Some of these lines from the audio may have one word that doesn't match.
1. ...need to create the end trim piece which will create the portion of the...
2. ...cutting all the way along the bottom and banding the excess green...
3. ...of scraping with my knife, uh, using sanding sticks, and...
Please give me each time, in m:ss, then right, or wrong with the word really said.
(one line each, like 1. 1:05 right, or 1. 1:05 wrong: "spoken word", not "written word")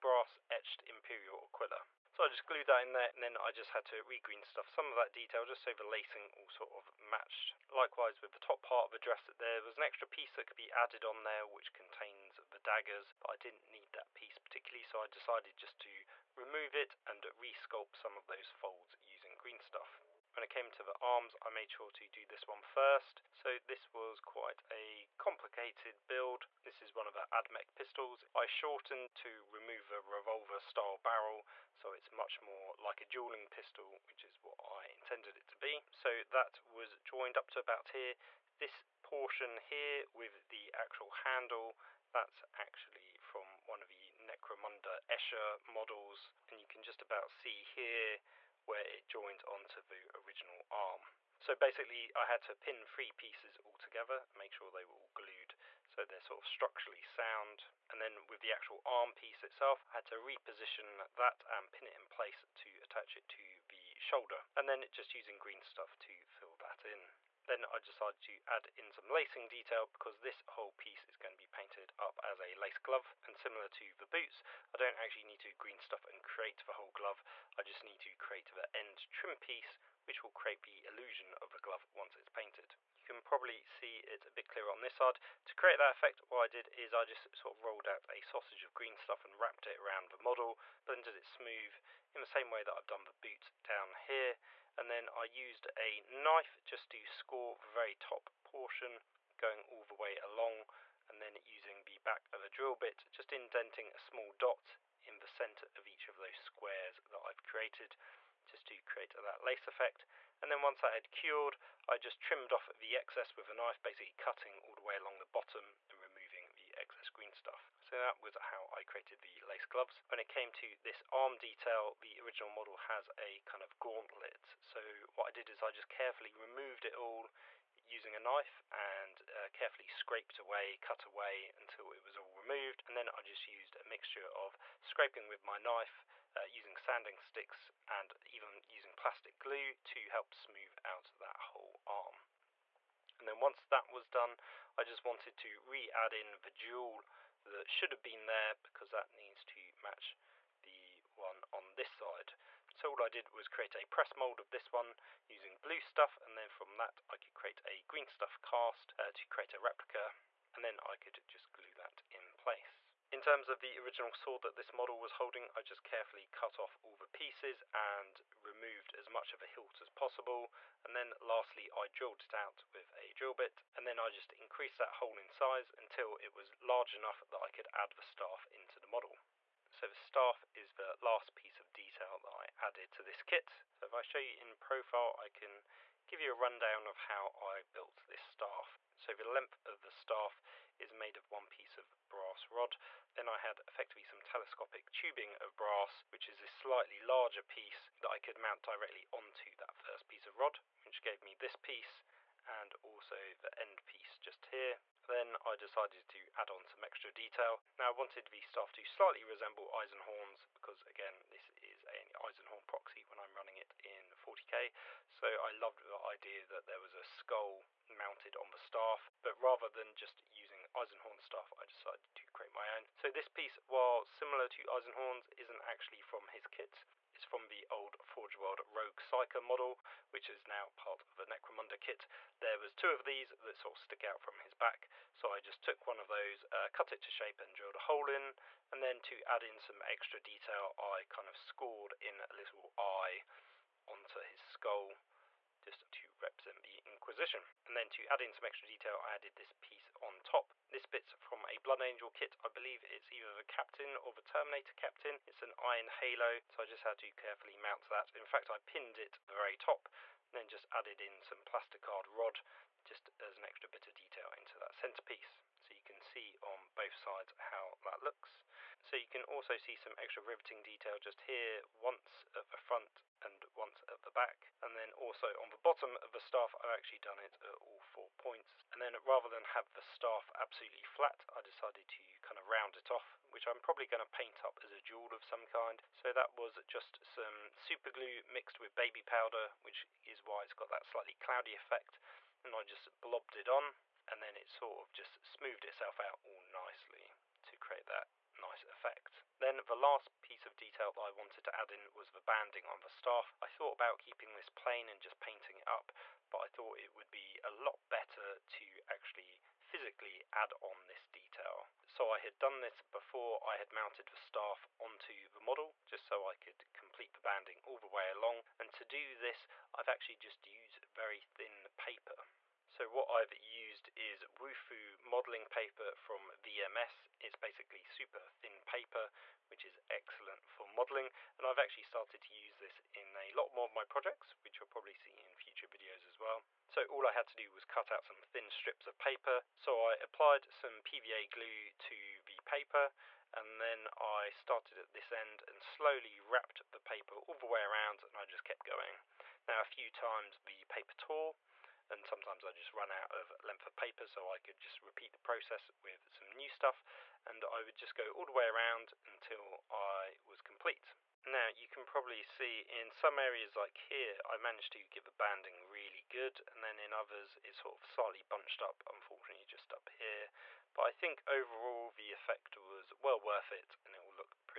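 1. 1:17 wrong: "illusion", not "portion"
2. 1:54 wrong: "removing", not "banding"
3. 2:14 right.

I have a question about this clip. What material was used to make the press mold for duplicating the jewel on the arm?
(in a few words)
blue stuff.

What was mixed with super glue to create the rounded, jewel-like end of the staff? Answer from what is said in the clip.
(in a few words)
baby powder.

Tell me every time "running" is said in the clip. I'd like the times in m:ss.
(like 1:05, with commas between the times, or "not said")
3:33.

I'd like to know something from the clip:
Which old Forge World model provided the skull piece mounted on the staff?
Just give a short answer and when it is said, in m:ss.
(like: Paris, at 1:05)
Rogue Psyker, at 3:48.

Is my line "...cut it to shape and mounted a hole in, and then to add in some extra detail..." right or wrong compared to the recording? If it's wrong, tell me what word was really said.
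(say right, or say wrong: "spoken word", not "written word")
wrong: "drilled", not "mounted".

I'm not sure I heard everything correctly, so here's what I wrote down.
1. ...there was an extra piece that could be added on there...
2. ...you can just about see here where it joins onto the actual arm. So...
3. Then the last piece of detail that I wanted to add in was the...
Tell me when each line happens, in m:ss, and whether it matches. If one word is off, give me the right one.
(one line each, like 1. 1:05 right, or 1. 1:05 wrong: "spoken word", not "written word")
1. 0:09 right
2. 0:46 wrong: "original", not "actual"
3. 4:59 right.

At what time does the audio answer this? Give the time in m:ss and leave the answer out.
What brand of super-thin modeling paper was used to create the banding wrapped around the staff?
5:24.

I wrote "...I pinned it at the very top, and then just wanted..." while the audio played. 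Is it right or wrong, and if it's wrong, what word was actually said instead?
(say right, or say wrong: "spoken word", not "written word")
wrong: "added", not "wanted".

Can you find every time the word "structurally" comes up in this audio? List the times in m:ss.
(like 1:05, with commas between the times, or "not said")
0:56.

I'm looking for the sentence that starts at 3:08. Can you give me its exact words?
So the length of the staff is made of one piece of brass rod.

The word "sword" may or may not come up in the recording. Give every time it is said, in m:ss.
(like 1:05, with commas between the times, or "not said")
2:44.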